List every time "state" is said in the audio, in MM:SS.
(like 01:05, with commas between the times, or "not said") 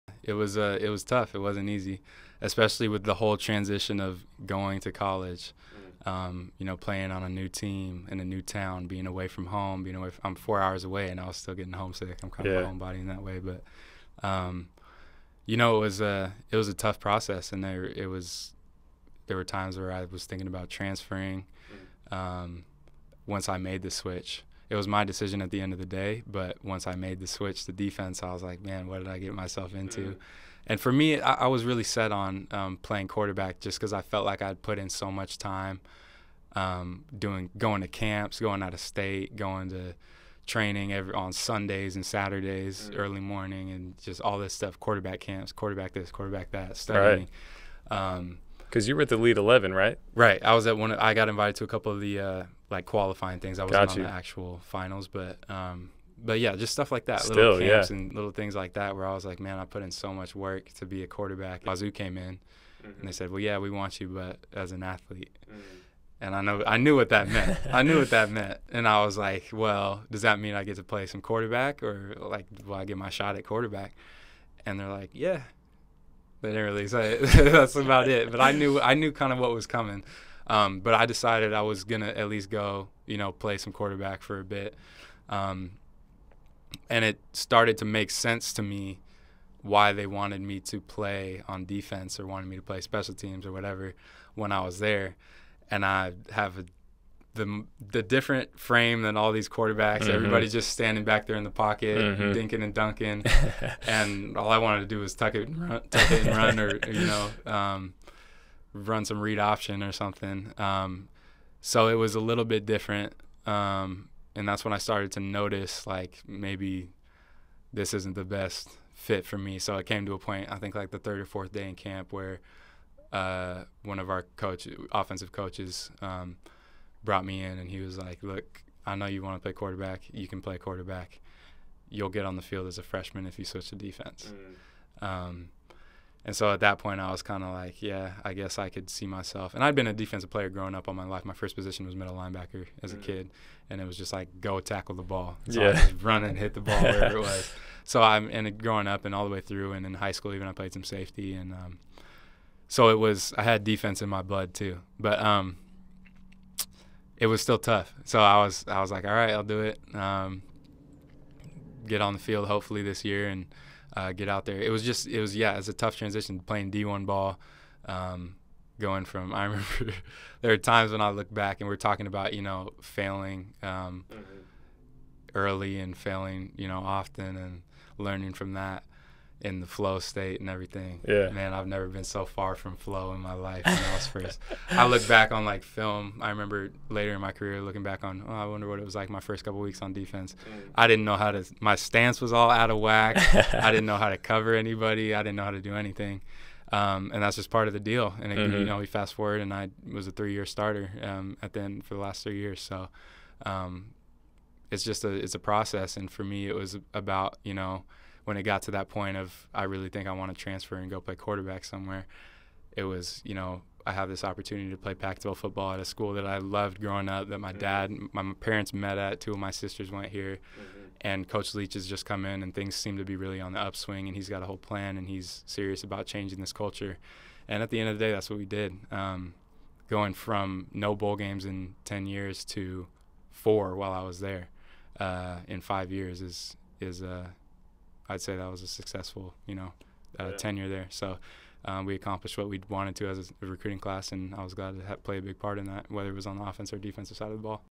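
00:38, 02:59.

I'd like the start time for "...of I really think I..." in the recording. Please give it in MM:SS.
03:29.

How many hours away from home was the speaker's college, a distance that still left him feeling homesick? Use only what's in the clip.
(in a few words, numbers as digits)
4.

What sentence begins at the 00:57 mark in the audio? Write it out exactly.
and little things like that, where I was like, man, I put in so much work to be a quarterback.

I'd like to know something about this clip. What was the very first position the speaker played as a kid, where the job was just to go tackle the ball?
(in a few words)
Middle linebacker.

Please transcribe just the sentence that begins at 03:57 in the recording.
Uh, I'd say that was a successful, you know, uh, yeah.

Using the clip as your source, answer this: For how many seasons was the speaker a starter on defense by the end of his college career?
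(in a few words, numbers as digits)
3.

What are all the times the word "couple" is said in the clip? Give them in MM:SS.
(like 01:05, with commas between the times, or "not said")
00:51, 03:09.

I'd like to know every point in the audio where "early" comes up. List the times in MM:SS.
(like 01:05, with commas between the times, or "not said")
00:43, 02:55.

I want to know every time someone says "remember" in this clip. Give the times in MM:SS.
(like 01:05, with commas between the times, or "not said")
02:49, 03:06.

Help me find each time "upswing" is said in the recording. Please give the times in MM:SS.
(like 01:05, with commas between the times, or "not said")
03:43.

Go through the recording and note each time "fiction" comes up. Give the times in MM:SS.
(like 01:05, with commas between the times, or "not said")
not said.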